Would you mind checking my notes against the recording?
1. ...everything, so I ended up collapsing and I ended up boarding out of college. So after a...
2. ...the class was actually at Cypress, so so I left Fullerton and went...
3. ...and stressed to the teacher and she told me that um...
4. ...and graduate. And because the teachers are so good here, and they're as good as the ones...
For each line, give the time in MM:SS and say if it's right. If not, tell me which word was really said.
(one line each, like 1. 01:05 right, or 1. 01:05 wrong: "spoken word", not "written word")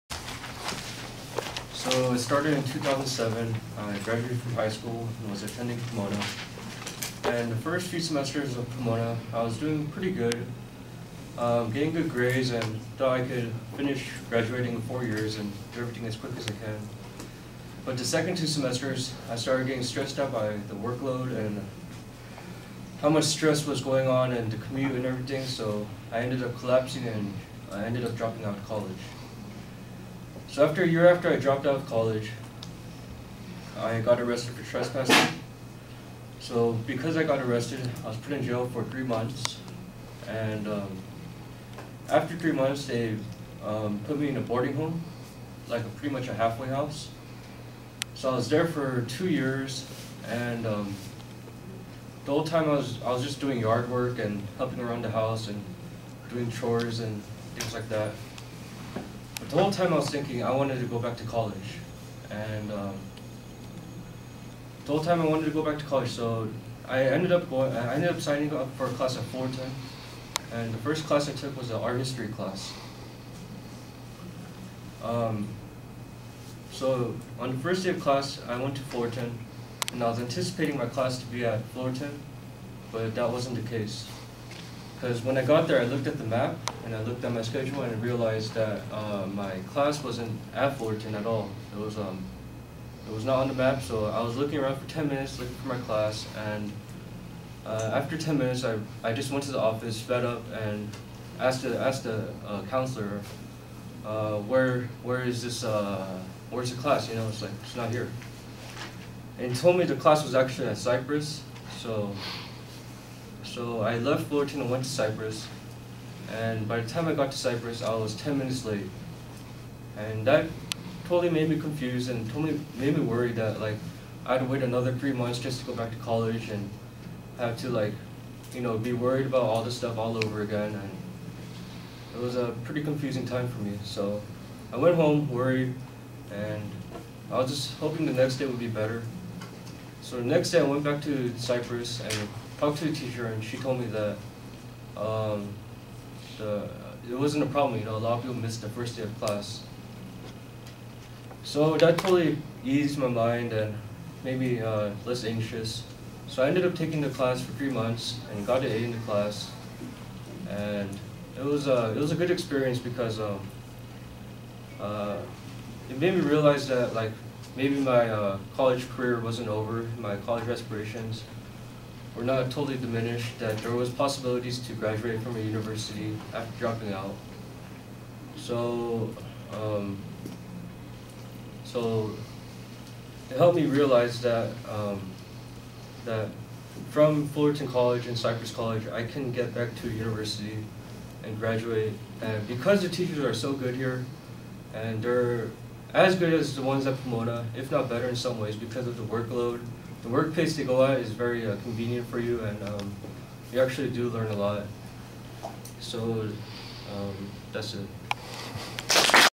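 1. 00:25 wrong: "dropping", not "boarding"
2. 01:49 right
3. 02:22 wrong: "talked", not "stressed"
4. 03:11 right.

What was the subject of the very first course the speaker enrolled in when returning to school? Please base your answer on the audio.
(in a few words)
Art history.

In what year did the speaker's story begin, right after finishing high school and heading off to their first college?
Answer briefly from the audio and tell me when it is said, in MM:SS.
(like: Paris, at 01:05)
2007, at 00:02.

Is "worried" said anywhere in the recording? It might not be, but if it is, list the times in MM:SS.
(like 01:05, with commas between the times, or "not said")
02:03, 02:08, 02:15.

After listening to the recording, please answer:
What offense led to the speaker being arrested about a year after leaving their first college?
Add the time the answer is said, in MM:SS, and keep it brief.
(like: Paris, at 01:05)
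Trespassing, at 00:34.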